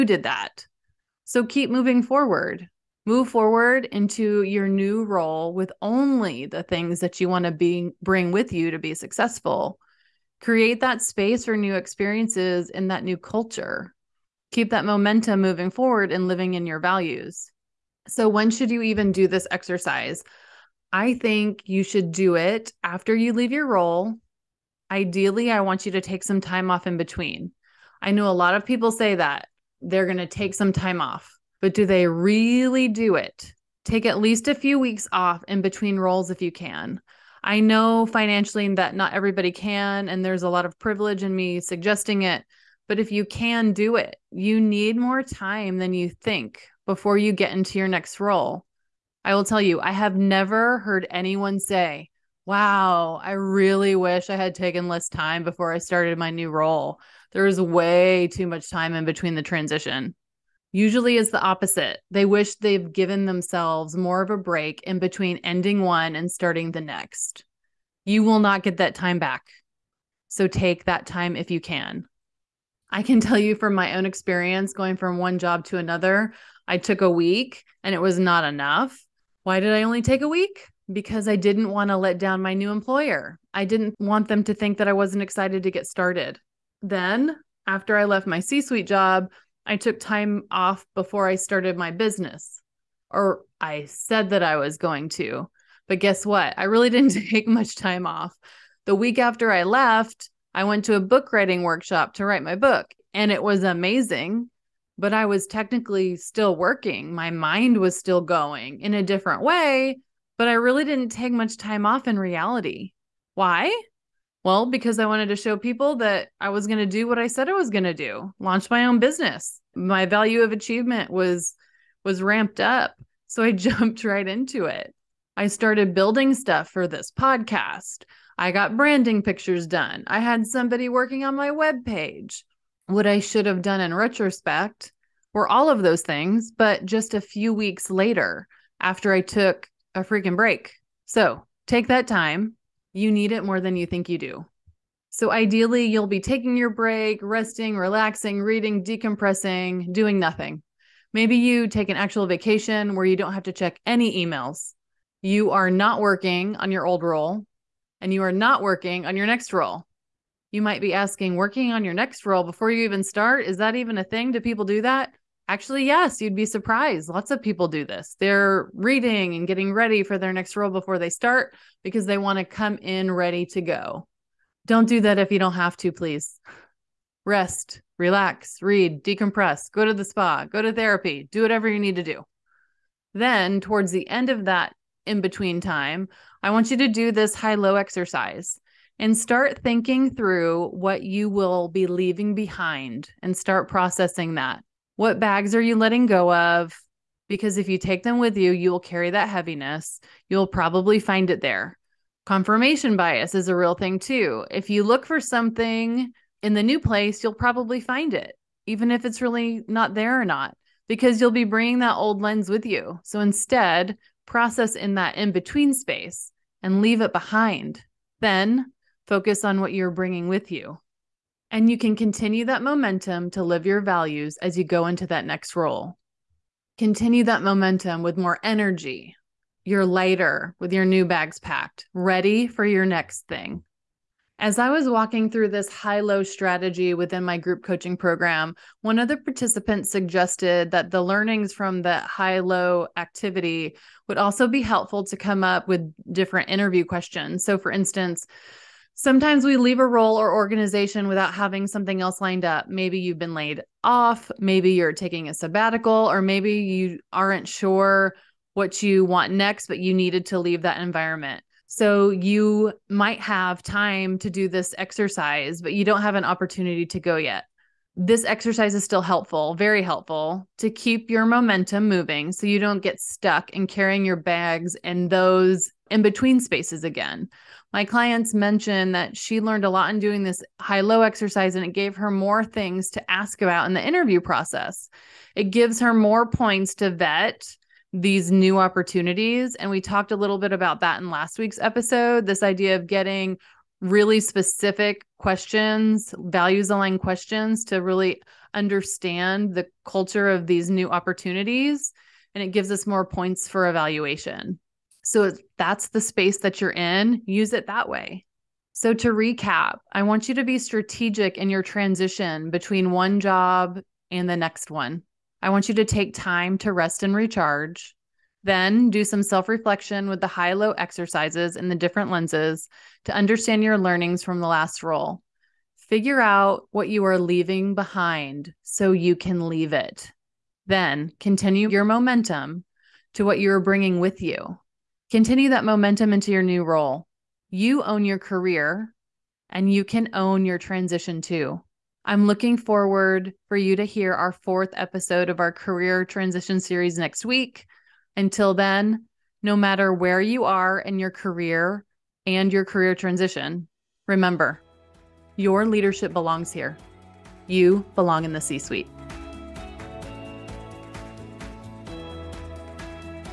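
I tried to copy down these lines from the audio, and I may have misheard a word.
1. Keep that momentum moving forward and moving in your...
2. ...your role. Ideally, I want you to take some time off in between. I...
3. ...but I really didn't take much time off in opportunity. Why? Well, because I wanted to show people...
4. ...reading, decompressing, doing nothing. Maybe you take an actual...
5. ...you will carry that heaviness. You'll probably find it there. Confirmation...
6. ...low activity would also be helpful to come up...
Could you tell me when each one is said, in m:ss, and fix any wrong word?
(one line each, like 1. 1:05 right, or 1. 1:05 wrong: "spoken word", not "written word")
1. 0:14 wrong: "living", not "moving"
2. 0:23 right
3. 1:50 wrong: "reality", not "opportunity"
4. 2:28 right
5. 3:18 right
6. 4:02 right.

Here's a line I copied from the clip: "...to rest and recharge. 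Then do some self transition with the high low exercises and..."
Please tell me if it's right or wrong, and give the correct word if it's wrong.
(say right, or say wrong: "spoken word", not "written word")
wrong: "reflection", not "transition".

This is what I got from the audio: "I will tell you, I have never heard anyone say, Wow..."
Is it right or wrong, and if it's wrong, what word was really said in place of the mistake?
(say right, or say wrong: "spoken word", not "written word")
right.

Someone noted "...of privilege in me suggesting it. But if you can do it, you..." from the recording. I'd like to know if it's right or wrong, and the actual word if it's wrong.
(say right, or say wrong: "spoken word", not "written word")
right.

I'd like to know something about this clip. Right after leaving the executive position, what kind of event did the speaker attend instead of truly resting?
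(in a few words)
book writing workshop.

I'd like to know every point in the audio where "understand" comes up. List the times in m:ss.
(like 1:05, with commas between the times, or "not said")
4:58, 5:23.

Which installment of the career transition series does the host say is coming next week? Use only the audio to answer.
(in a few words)
fourth.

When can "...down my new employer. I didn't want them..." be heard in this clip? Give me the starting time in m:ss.
1:22.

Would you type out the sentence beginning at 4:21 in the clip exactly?
So you might have time to do this exercise, but you don't have an opportunity to go yet.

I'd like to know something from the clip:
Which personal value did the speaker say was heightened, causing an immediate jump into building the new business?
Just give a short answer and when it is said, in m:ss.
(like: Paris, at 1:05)
achievement, at 2:00.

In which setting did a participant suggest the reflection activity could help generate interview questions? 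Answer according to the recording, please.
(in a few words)
group coaching program.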